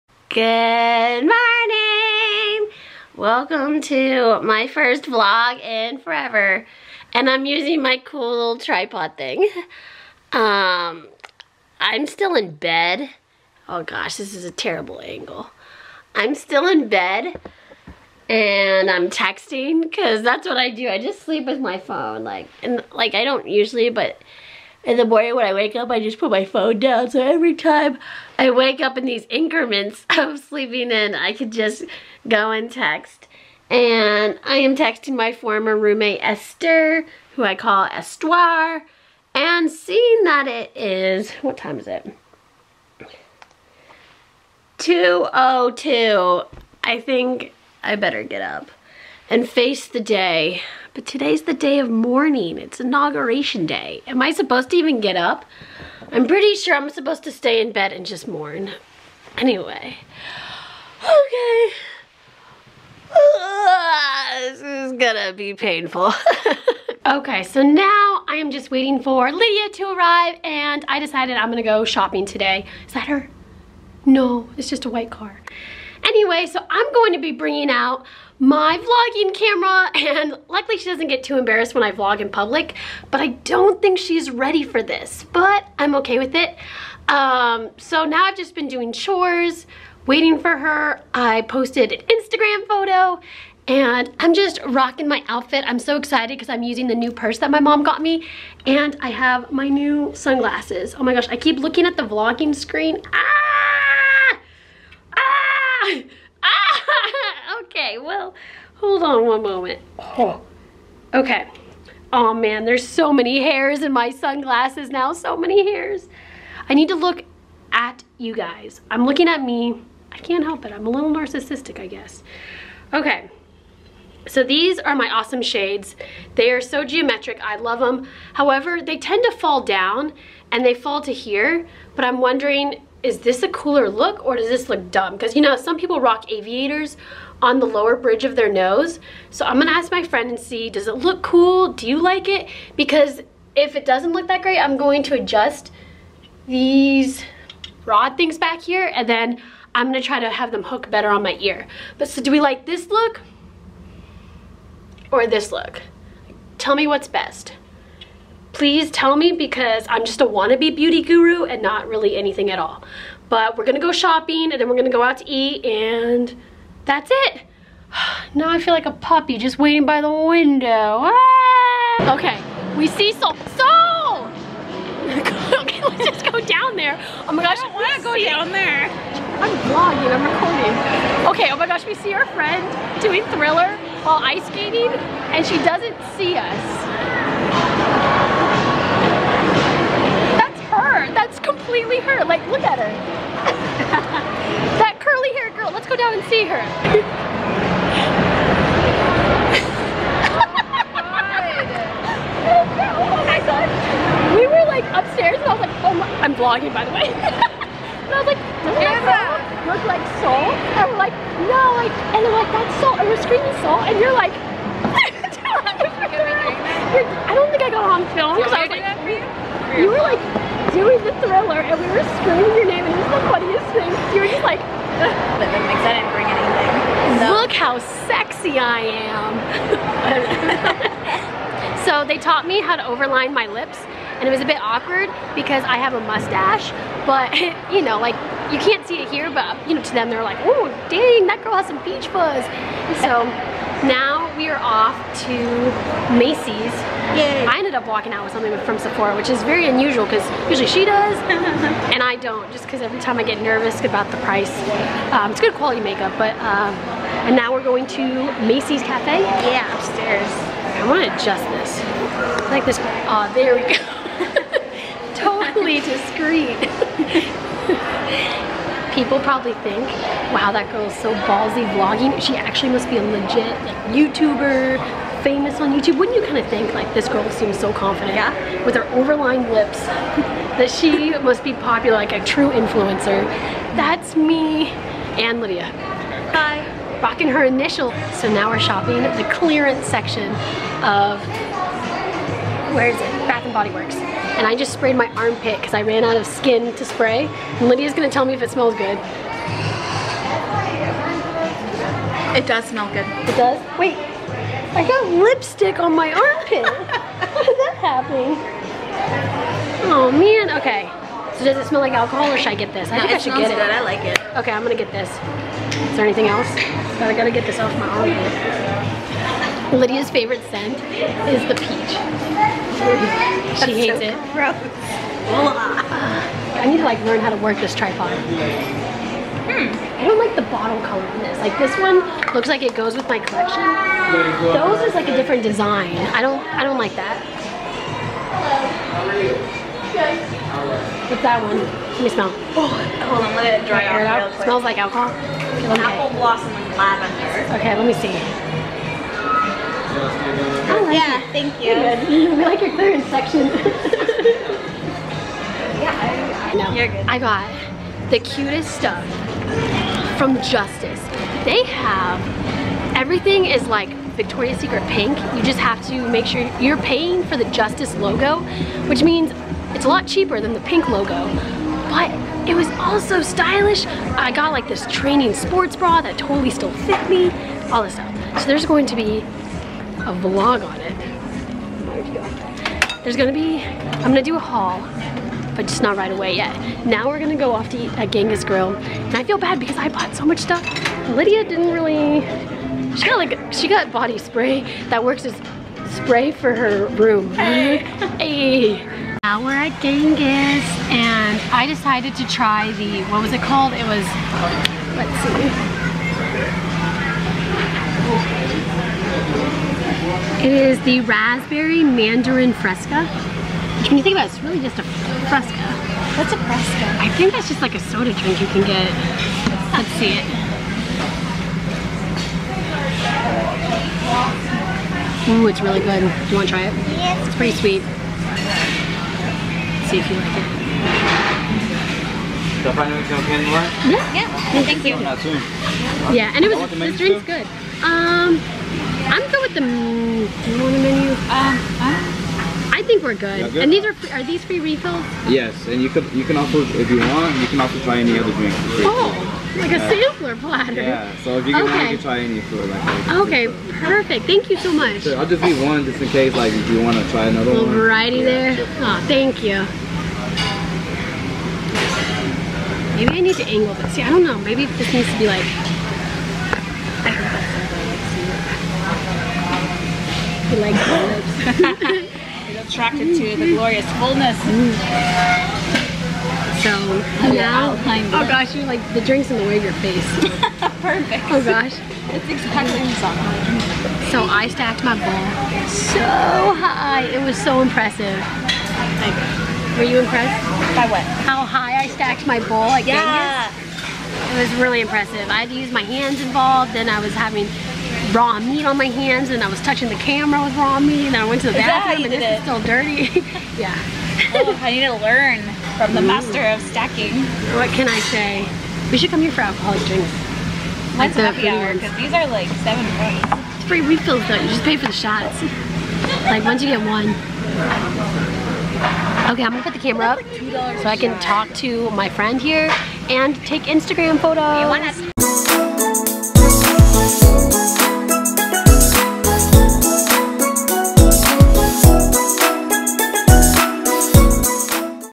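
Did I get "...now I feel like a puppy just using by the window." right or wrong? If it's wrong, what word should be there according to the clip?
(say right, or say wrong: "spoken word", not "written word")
wrong: "waiting", not "using".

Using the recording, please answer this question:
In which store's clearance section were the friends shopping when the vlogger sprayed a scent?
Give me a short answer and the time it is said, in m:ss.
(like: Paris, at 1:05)
Bath and Body Works, at 4:53.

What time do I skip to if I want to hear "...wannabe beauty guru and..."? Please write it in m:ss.
2:40.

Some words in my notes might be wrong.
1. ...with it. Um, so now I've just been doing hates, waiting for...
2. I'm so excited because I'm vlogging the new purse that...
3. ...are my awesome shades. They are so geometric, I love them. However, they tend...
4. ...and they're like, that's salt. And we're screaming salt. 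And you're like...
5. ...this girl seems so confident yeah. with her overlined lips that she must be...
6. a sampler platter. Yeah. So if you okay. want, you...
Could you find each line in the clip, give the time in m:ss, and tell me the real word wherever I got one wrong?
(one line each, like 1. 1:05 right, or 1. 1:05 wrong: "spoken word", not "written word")
1. 1:26 wrong: "chores", not "hates"
2. 1:35 wrong: "using", not "vlogging"
3. 2:04 right
4. 3:32 right
5. 4:36 right
6. 7:29 right.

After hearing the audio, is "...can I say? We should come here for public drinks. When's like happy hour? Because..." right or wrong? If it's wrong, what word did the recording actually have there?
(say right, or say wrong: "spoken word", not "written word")
wrong: "alcoholic", not "public".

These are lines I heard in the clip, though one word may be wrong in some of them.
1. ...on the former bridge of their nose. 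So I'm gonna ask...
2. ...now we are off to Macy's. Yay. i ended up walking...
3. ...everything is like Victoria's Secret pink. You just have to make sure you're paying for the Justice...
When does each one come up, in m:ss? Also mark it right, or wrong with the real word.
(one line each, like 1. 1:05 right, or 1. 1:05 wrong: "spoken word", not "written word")
1. 2:17 wrong: "lower", not "former"
2. 4:03 right
3. 6:02 right.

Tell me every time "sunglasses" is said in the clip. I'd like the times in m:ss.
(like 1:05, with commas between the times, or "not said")
1:40, 1:54.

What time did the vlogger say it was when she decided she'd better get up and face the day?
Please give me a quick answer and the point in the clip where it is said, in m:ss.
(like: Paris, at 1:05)
2:02, at 0:44.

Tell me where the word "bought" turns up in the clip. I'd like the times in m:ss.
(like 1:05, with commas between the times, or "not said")
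6:29.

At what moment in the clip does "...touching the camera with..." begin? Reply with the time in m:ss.
8:19.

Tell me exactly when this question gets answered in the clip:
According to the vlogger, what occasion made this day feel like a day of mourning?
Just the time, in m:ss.
0:52.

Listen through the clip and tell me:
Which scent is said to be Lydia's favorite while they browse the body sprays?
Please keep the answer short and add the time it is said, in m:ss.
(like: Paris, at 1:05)
Peach, at 5:21.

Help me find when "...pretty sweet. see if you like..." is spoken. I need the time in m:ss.
7:07.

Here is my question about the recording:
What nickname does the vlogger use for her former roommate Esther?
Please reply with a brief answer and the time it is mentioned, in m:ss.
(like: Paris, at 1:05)
Estoire, at 0:37.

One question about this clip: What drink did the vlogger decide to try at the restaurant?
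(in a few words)
Raspberry mandarin fresca.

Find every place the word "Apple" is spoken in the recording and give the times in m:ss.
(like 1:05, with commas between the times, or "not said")
5:45.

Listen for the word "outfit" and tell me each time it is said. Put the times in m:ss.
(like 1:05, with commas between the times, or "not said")
1:35.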